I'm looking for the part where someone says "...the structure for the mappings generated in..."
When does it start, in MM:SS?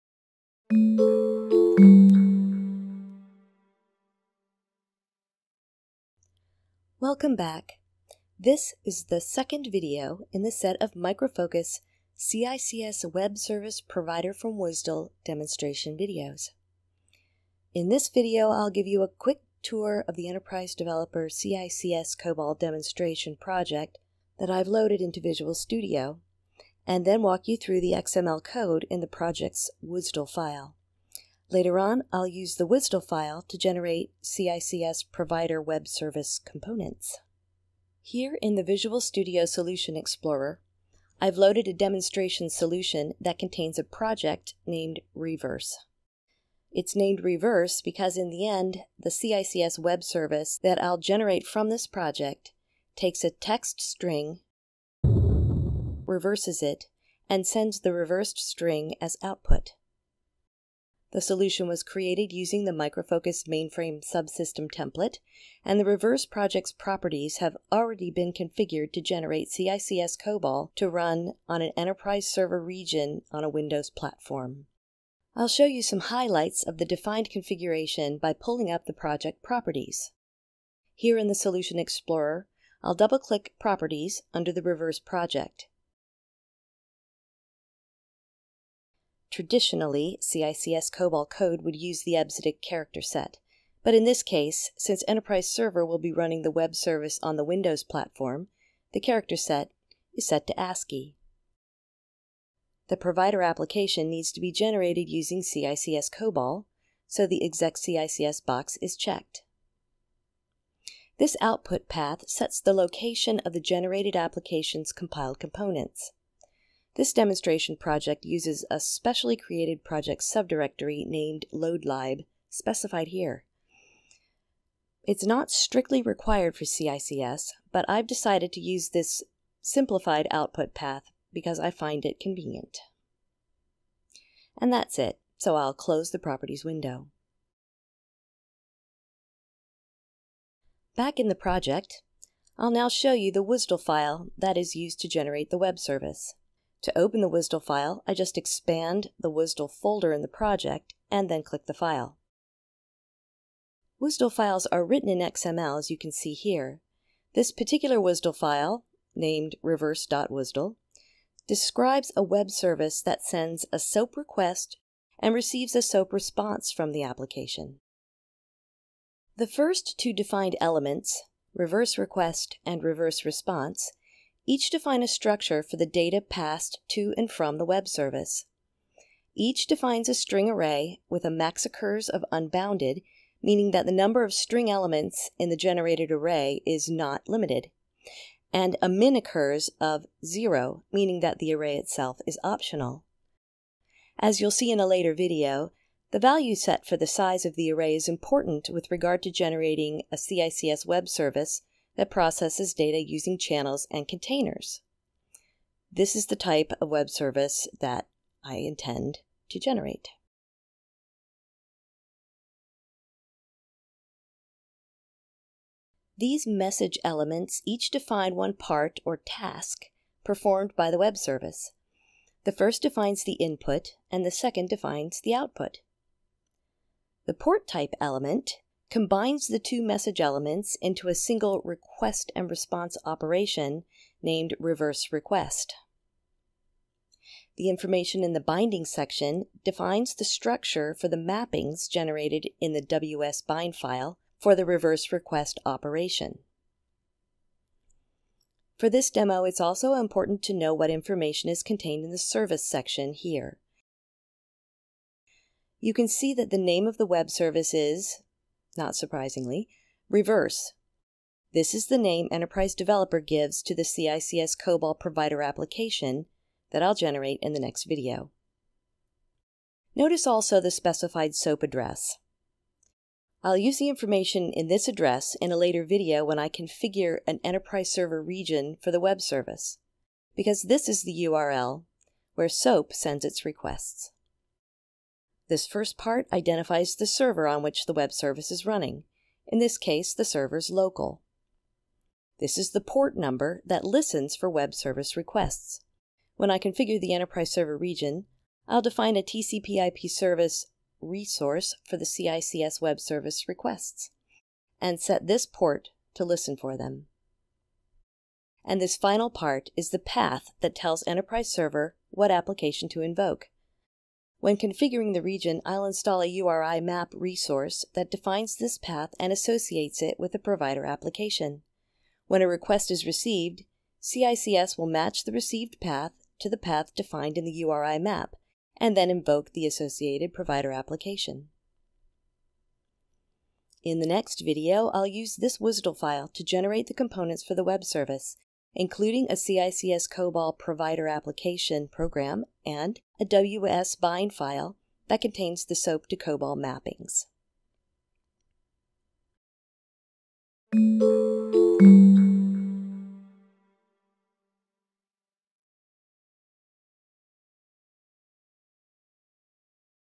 04:00.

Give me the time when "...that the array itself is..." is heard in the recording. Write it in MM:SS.
03:11.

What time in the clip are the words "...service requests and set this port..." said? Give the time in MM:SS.
05:03.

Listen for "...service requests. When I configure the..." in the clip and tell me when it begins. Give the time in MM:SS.
04:54.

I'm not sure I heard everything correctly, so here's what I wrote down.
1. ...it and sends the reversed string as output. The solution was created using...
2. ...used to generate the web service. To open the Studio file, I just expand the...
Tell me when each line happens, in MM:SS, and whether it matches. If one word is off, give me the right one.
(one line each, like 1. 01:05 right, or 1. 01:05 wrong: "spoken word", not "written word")
1. 00:56 right
2. 02:24 wrong: "WSDL", not "Studio".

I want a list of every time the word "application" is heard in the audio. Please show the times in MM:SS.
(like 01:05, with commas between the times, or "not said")
01:43, 01:54, 02:47, 04:25, 05:12, 05:20, 05:30, 05:41.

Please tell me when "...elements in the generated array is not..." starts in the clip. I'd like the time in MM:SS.
03:04.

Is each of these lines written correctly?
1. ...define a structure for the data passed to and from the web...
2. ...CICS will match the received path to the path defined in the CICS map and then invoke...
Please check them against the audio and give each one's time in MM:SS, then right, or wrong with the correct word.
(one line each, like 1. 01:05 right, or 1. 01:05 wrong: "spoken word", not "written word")
1. 02:54 right
2. 05:24 wrong: "URI", not "CICS".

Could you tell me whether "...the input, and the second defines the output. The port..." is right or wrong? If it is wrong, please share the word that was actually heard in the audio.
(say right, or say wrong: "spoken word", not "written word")
right.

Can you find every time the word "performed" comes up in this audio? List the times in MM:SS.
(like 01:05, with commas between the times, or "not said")
03:40.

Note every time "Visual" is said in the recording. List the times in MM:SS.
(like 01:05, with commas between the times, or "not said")
00:25, 00:38.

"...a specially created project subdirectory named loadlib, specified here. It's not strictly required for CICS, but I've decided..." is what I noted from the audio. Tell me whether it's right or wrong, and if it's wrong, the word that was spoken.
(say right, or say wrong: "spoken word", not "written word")
right.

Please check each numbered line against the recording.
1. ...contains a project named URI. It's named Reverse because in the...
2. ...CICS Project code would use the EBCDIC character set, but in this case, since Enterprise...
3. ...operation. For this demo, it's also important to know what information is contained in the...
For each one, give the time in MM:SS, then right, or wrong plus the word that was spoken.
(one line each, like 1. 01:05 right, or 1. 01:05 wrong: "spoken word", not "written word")
1. 00:43 wrong: "Reverse", not "URI"
2. 01:30 wrong: "COBOL", not "Project"
3. 04:05 right.